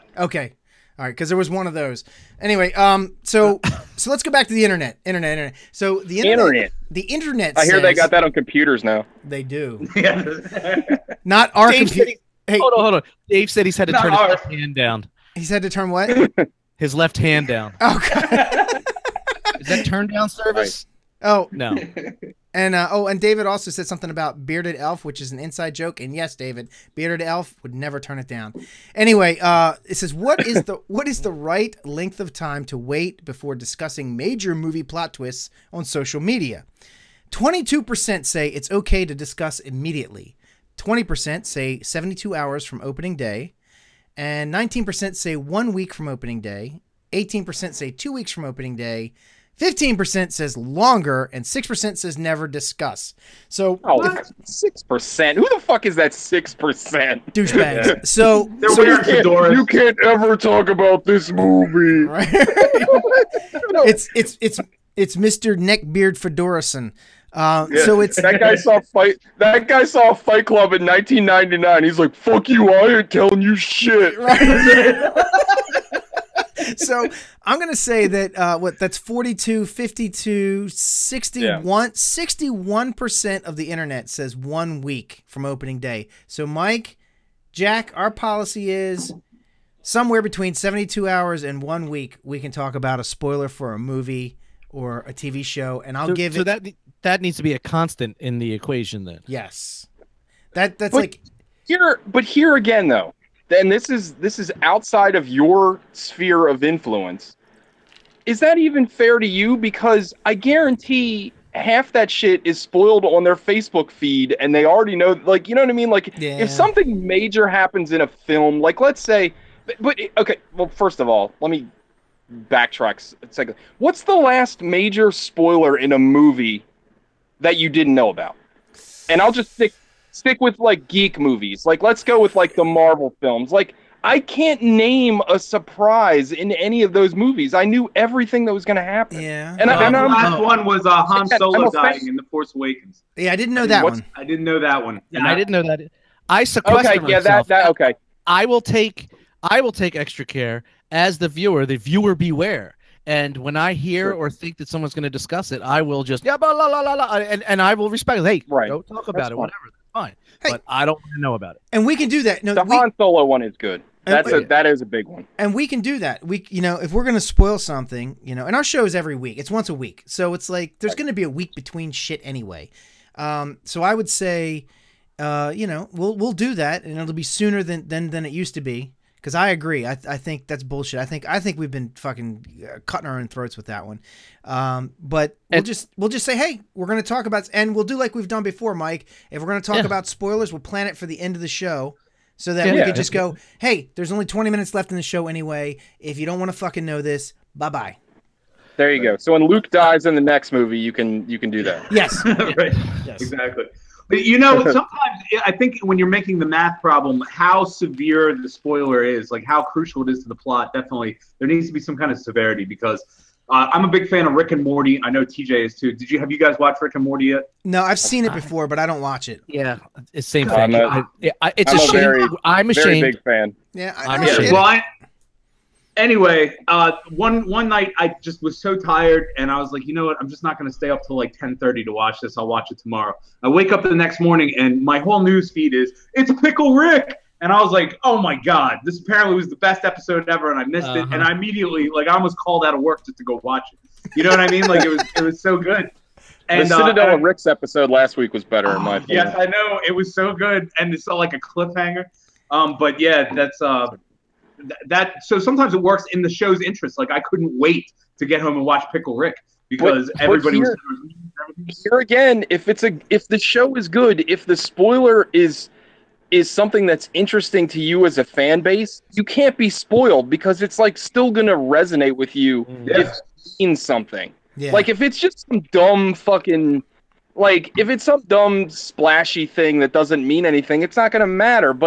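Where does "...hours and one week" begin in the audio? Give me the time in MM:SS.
01:31.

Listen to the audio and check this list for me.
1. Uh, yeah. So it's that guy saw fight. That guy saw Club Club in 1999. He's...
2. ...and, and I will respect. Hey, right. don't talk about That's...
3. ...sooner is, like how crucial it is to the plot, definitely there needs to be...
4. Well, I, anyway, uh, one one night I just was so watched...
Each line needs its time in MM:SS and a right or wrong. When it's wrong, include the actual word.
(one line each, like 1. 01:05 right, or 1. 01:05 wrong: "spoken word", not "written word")
1. 01:07 wrong: "Fight", not "Club"
2. 02:37 right
3. 03:28 wrong: "spoiler", not "sooner"
4. 03:44 wrong: "tired", not "watched".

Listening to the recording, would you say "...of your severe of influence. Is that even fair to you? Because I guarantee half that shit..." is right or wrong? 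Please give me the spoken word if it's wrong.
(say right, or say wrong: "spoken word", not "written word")
wrong: "sphere", not "severe".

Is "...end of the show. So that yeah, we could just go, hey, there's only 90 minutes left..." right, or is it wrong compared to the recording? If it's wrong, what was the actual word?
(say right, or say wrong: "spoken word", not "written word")
wrong: "20", not "90".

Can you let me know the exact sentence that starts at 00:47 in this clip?
Eighteen percent say two weeks from opening day.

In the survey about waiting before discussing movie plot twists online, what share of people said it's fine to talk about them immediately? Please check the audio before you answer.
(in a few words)
22%.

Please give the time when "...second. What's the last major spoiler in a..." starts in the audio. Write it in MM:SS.
02:03.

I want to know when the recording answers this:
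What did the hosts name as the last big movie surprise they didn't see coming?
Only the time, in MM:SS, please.
02:21.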